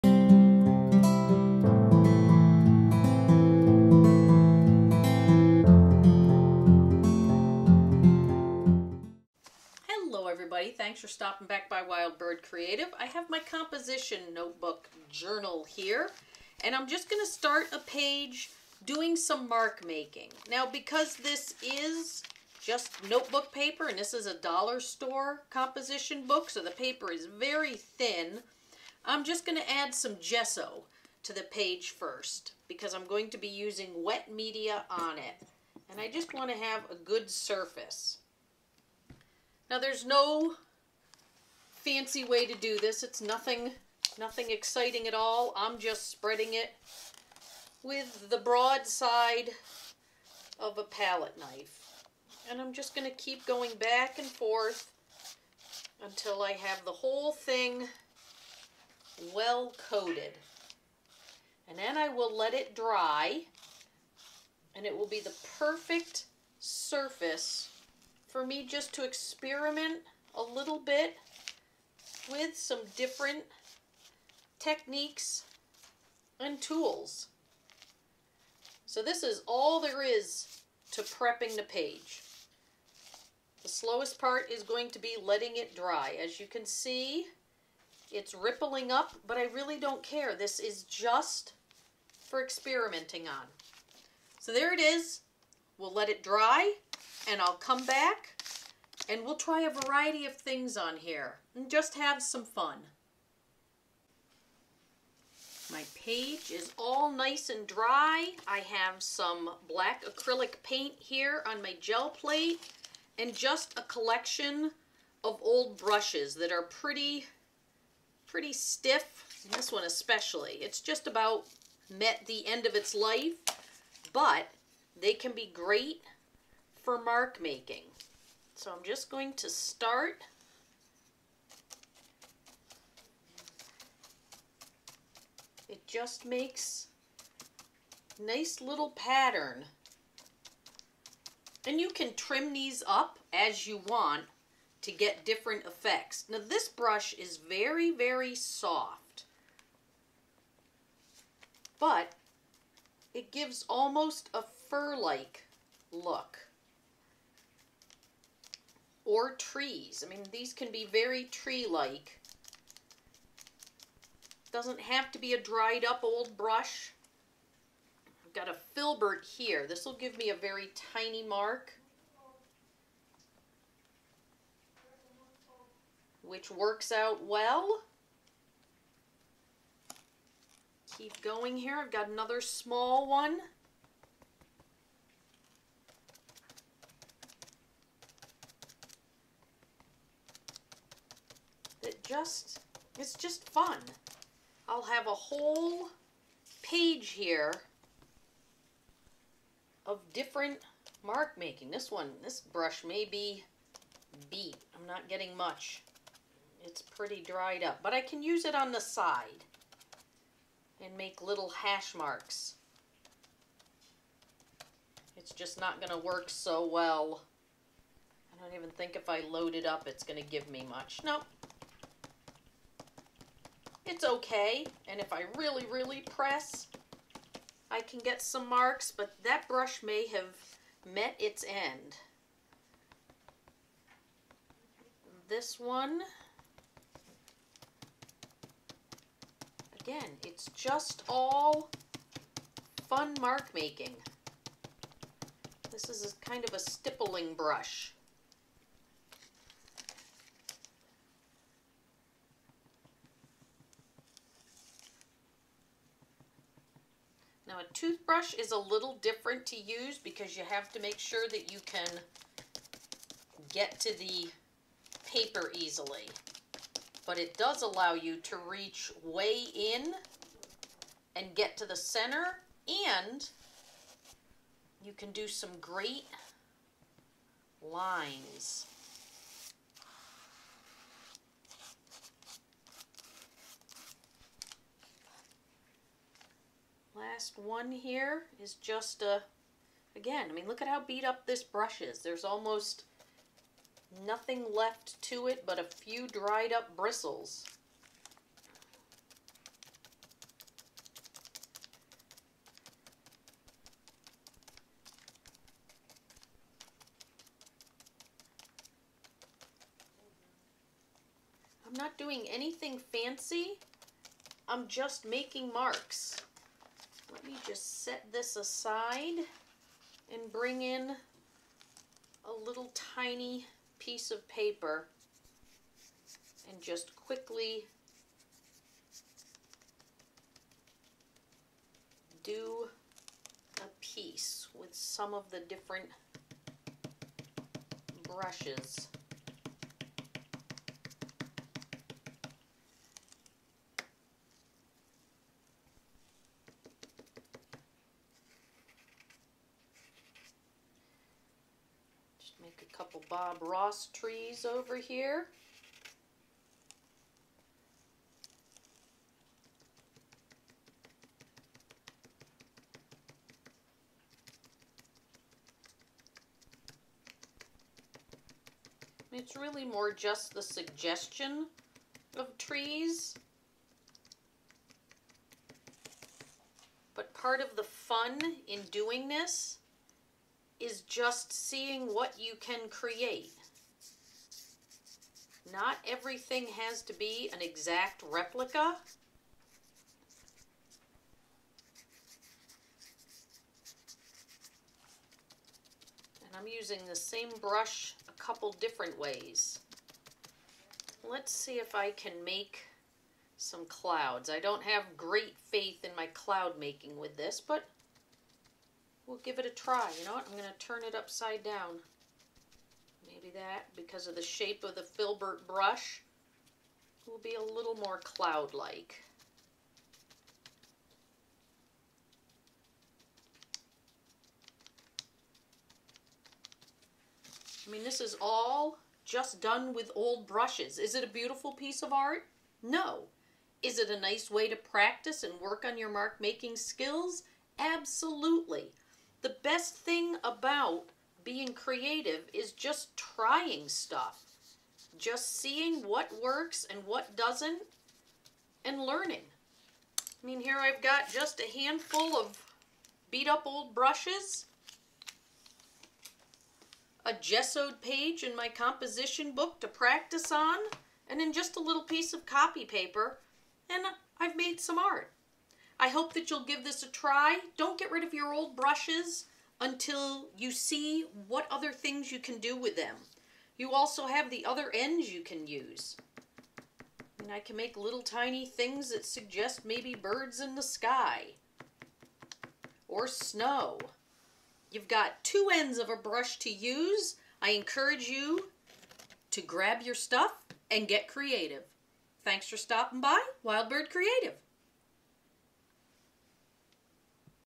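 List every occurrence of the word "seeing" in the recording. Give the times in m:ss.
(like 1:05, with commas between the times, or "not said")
6:21, 7:25.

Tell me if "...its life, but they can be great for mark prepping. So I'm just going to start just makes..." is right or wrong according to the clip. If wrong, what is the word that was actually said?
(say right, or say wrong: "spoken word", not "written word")
wrong: "making", not "prepping".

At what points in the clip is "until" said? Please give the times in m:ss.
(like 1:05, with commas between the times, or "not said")
0:56, 7:49.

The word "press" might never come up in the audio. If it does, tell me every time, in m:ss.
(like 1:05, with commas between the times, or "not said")
3:46.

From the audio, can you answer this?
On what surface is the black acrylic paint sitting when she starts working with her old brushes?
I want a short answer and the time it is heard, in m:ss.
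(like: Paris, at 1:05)
gel plate, at 1:51.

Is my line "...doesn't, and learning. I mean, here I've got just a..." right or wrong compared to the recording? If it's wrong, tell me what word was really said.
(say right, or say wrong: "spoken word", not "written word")
right.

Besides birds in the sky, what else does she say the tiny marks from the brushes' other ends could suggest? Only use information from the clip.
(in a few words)
snow.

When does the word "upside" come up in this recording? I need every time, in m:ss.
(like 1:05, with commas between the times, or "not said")
6:50.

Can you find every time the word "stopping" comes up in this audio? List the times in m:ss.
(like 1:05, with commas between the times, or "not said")
0:11, 8:12.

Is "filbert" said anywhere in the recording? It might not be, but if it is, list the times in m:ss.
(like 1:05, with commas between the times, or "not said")
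2:48, 6:54.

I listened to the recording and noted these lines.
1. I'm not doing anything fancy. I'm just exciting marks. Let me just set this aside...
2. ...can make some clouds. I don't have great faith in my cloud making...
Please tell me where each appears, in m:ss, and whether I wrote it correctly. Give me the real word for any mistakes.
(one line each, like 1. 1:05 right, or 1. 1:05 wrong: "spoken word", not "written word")
1. 5:11 wrong: "making", not "exciting"
2. 6:41 right.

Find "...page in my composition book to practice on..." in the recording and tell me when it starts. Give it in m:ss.
7:37.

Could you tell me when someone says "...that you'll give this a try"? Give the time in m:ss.
7:46.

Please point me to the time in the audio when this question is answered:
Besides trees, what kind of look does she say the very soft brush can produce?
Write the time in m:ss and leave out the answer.
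2:34.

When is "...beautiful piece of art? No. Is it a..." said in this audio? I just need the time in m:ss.
7:11.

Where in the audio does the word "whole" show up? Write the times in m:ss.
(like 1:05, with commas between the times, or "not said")
0:56, 3:15.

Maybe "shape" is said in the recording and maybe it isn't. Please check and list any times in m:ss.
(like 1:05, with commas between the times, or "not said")
6:54.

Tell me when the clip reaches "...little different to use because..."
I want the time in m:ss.
4:18.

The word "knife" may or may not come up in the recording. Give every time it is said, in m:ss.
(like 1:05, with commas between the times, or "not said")
0:51.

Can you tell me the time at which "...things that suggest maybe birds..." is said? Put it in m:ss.
7:58.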